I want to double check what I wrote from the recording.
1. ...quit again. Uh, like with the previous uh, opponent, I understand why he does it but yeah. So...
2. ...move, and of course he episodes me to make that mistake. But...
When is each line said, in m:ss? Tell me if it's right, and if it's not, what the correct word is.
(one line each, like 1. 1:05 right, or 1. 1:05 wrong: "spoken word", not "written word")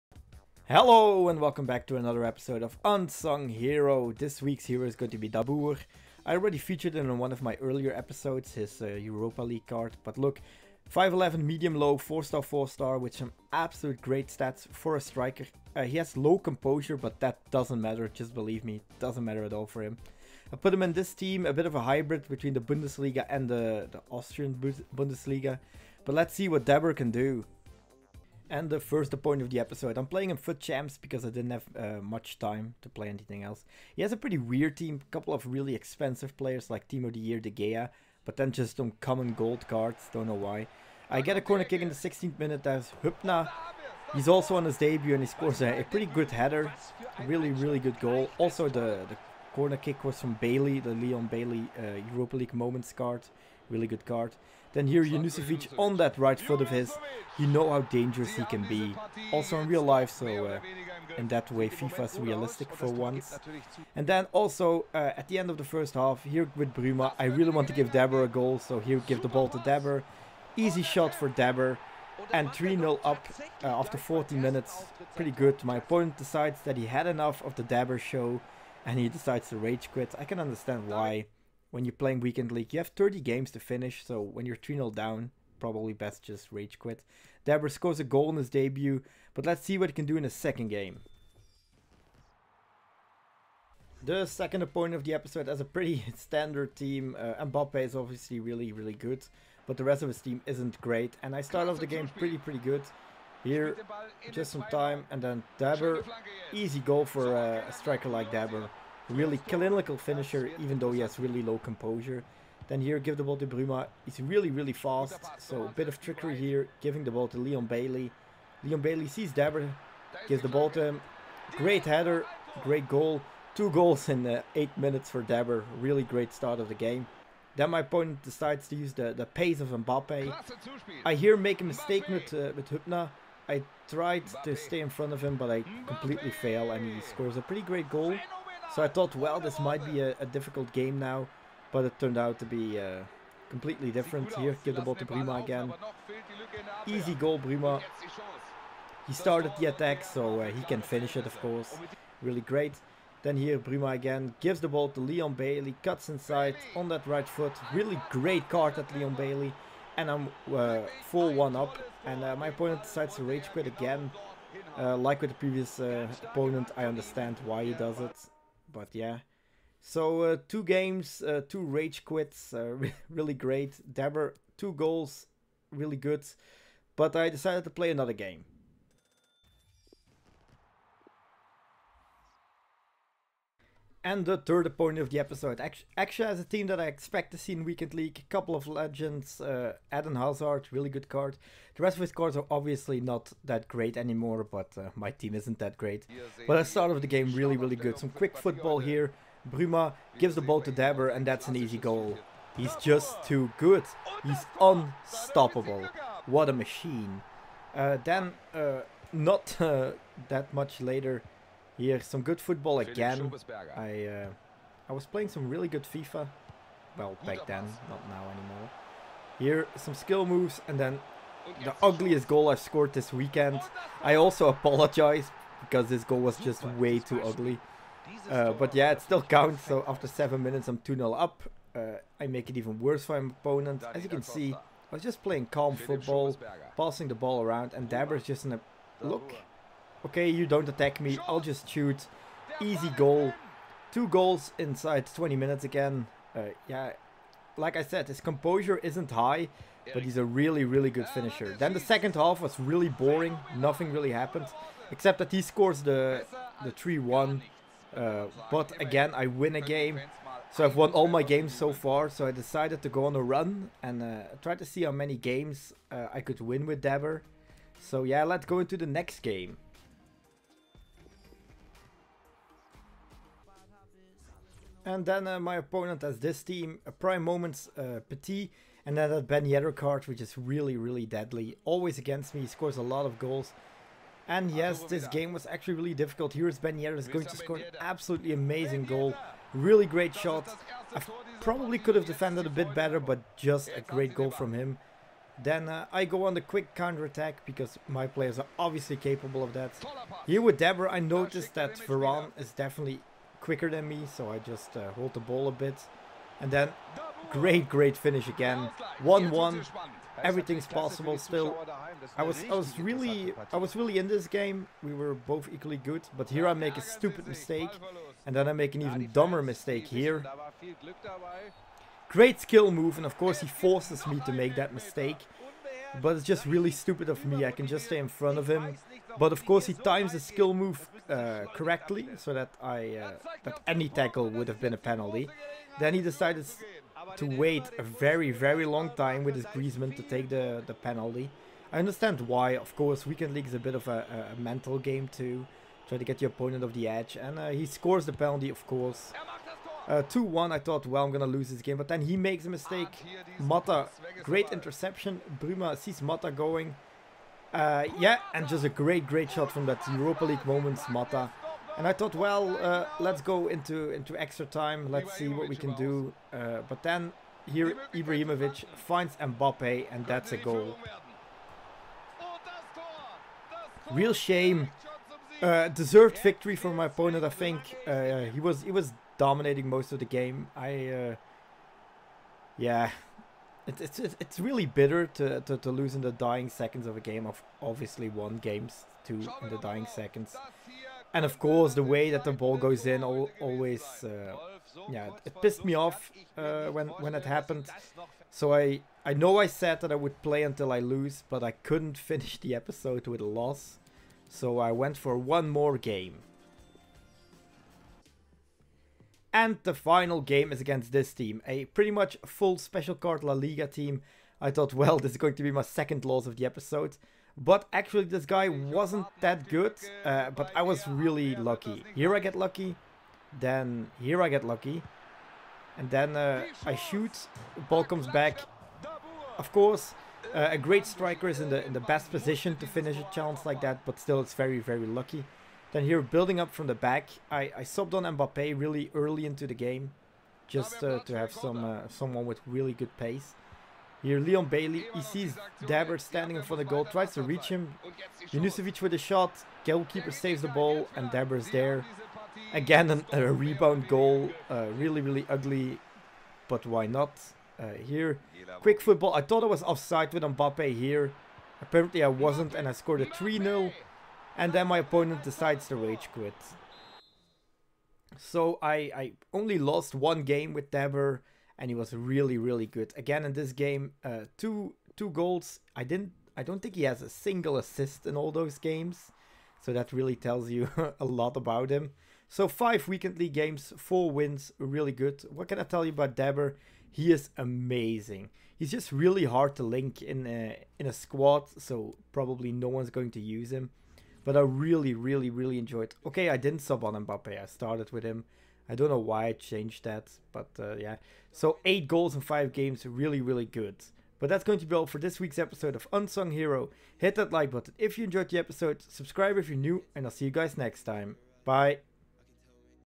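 1. 2:43 right
2. 5:22 wrong: "forces", not "episodes".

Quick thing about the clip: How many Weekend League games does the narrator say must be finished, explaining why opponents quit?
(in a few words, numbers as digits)
30.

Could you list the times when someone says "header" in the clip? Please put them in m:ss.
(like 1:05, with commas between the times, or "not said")
0:46, 2:01.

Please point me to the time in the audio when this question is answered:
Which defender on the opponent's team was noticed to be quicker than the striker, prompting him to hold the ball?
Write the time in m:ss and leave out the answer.
5:01.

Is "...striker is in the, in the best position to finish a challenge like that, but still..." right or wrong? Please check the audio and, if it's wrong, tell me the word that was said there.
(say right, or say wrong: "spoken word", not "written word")
right.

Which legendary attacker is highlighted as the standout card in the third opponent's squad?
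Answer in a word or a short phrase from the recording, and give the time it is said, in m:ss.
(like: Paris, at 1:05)
Eden Hazard, at 3:09.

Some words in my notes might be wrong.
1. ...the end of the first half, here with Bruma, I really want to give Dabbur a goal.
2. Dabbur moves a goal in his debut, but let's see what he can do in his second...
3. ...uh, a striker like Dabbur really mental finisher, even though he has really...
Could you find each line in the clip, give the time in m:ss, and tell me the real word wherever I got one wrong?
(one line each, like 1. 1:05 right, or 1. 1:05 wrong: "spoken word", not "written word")
1. 1:05 right
2. 1:27 wrong: "scores", not "moves"
3. 1:47 wrong: "clinical", not "mental".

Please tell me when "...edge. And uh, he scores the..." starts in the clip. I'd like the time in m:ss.
5:46.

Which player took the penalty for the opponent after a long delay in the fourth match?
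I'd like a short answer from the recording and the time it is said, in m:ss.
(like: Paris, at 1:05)
Griezmann, at 5:39.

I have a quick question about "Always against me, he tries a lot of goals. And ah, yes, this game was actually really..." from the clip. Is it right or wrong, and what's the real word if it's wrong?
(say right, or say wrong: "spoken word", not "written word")
wrong: "scores", not "tries".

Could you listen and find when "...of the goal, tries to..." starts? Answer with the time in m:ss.
7:26.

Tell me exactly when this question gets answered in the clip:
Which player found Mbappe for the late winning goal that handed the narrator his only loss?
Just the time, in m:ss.
6:07.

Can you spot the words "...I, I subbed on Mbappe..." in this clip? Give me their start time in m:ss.
7:17.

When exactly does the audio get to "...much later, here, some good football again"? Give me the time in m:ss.
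3:30.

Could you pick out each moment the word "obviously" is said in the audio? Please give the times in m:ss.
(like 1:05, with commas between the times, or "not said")
1:37, 3:12, 4:58, 6:27.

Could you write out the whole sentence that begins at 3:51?
Uh, I make it even worse for my opponent.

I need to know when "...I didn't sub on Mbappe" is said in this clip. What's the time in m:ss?
8:16.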